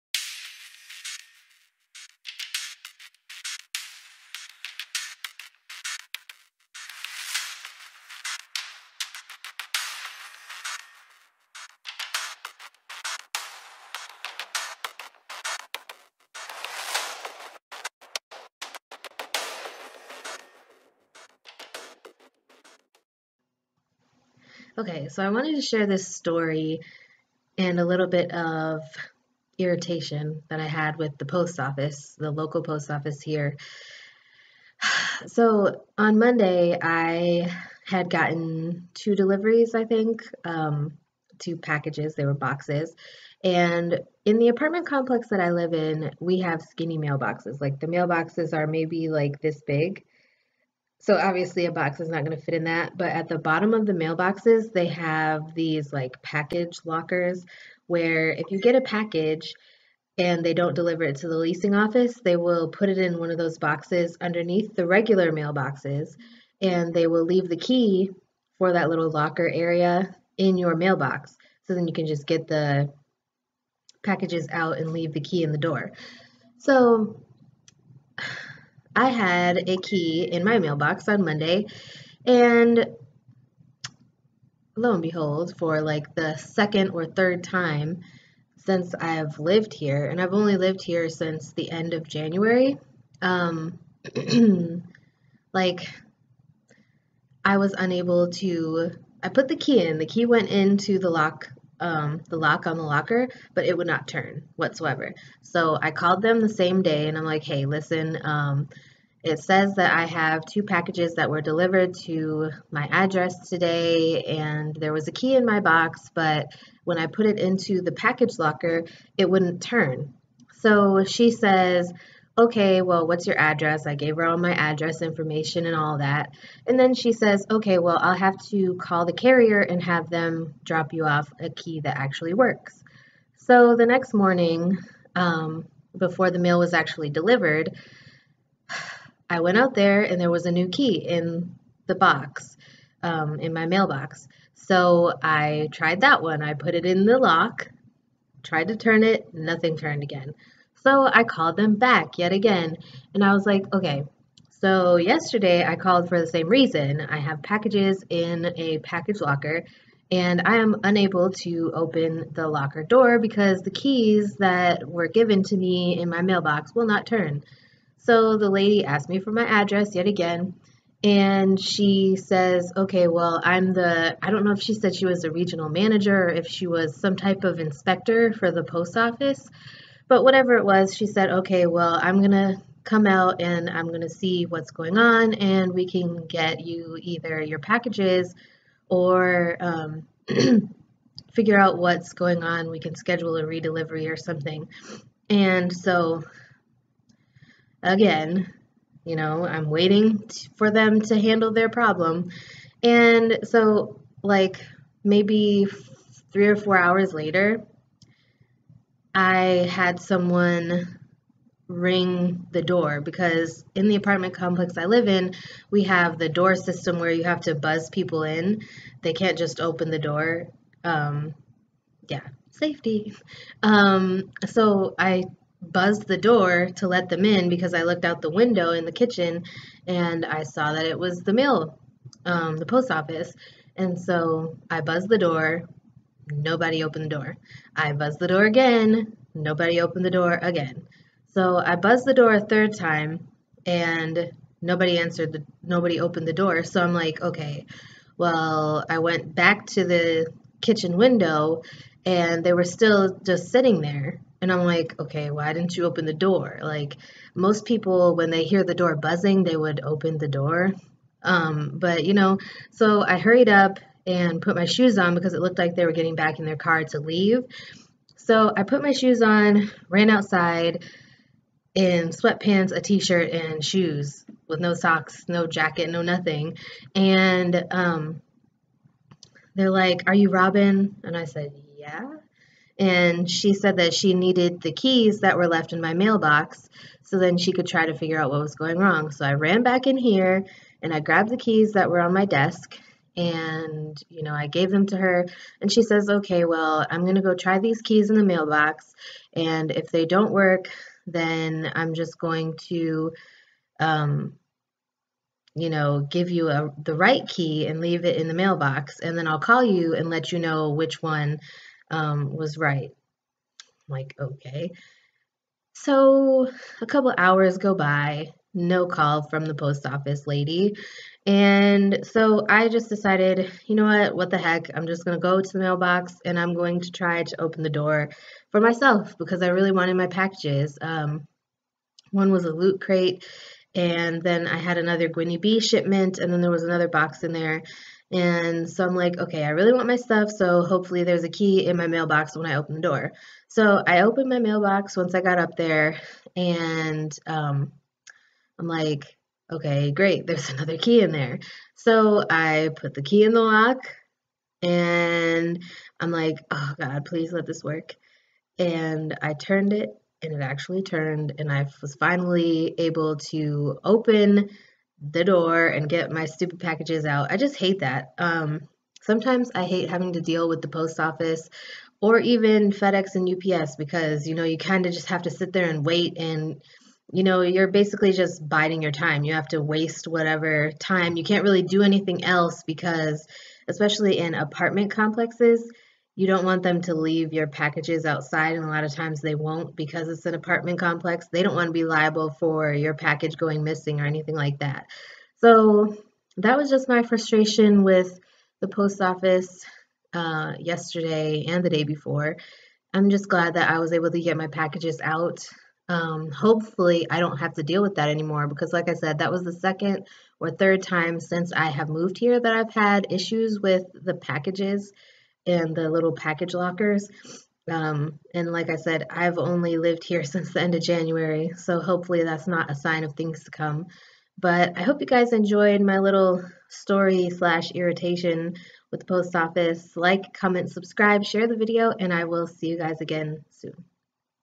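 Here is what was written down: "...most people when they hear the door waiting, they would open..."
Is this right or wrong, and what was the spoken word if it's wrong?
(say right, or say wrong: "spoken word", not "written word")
wrong: "buzzing", not "waiting".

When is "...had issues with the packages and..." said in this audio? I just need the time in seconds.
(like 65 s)
412 s.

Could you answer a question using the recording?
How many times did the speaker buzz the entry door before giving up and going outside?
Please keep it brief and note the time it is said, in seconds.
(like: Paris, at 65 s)
3, at 242 s.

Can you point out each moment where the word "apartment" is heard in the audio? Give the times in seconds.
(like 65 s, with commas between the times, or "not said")
44 s, 213 s, 384 s, 390 s.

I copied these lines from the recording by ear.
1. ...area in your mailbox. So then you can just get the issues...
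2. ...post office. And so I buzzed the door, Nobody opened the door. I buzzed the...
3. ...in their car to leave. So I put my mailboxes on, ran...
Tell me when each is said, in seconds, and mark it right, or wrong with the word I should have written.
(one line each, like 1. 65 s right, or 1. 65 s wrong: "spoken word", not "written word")
1. 69 s wrong: "packages", not "issues"
2. 232 s right
3. 266 s wrong: "shoes", not "mailboxes".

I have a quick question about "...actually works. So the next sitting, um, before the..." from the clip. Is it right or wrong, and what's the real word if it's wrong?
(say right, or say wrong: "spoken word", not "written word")
wrong: "morning", not "sitting".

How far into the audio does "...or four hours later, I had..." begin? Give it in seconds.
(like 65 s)
206 s.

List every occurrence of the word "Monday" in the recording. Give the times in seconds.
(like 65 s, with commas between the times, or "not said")
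36 s, 81 s.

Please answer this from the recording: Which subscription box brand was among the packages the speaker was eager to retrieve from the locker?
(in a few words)
Loot Crate.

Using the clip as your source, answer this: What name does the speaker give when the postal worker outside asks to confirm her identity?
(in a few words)
Robynne.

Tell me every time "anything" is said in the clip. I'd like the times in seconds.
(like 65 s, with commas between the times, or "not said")
381 s, 394 s.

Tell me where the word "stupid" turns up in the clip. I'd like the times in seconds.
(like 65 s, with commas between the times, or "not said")
366 s.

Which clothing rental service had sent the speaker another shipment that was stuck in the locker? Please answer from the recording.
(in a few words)
Gwynnie Bee.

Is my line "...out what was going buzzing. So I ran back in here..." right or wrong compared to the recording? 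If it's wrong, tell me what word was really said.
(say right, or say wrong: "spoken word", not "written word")
wrong: "wrong", not "buzzing".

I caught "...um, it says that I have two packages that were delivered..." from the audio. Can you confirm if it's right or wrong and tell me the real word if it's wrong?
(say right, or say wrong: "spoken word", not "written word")
right.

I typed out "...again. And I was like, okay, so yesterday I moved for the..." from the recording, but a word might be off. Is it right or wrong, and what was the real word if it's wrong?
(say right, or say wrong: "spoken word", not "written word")
wrong: "called", not "moved".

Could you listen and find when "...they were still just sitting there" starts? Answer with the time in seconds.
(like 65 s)
252 s.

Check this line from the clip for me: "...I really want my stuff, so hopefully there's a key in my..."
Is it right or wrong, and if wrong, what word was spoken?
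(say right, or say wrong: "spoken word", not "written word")
right.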